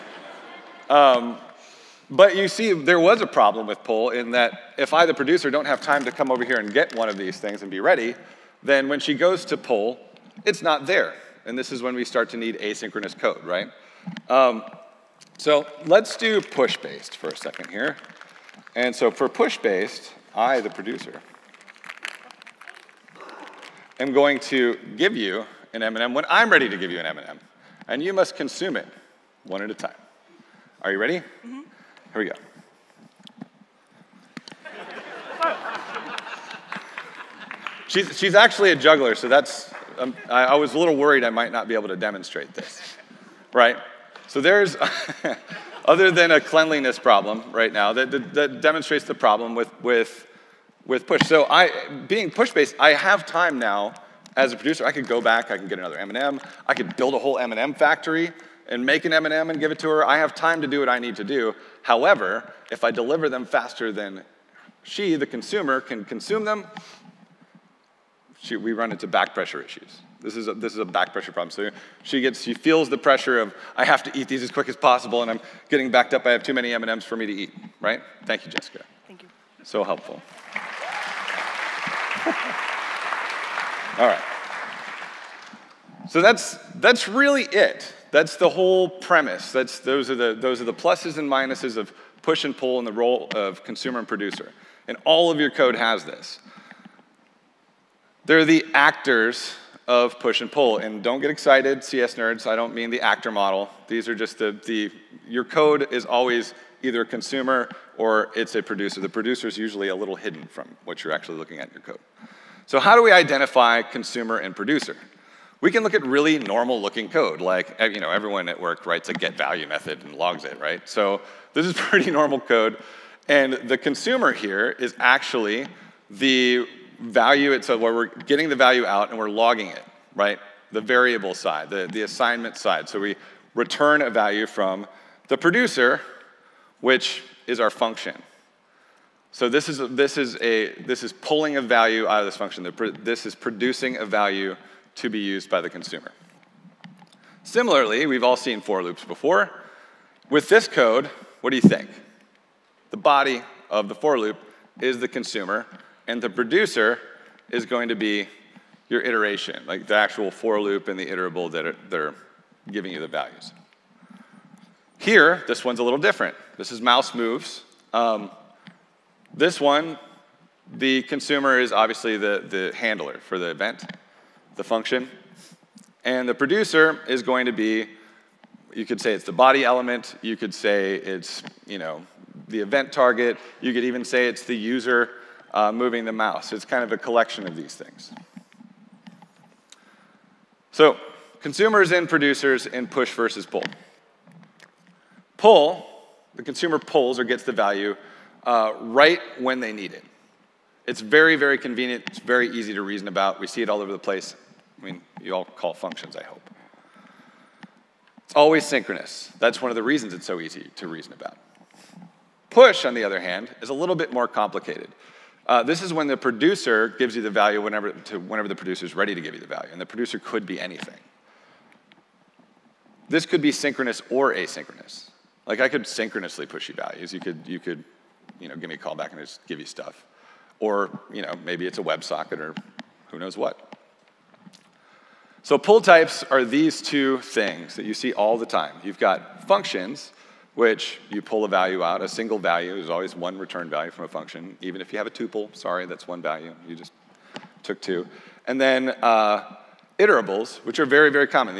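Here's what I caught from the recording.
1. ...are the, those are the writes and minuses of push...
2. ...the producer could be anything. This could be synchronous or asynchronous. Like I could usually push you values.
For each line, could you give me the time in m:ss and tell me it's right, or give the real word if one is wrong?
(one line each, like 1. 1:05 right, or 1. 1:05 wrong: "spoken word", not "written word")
1. 1:30 wrong: "pluses", not "writes"
2. 3:39 wrong: "synchronously", not "usually".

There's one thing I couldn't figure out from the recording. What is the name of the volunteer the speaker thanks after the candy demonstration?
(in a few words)
Jessica.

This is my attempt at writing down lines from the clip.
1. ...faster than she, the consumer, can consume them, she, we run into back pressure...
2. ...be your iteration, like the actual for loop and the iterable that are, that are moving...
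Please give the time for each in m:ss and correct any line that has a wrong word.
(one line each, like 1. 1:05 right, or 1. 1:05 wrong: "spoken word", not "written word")
1. 1:03 right
2. 2:37 wrong: "giving", not "moving".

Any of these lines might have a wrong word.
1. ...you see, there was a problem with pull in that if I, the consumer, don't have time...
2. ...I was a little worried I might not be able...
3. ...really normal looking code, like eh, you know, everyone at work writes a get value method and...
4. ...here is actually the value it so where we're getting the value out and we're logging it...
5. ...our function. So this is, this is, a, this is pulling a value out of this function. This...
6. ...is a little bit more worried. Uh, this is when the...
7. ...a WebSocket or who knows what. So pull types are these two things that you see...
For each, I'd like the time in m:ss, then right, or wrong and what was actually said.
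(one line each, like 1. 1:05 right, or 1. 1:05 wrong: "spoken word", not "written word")
1. 0:02 wrong: "producer", not "consumer"
2. 0:40 right
3. 1:56 right
4. 2:04 right
5. 2:17 right
6. 3:33 wrong: "complicated", not "worried"
7. 3:51 right.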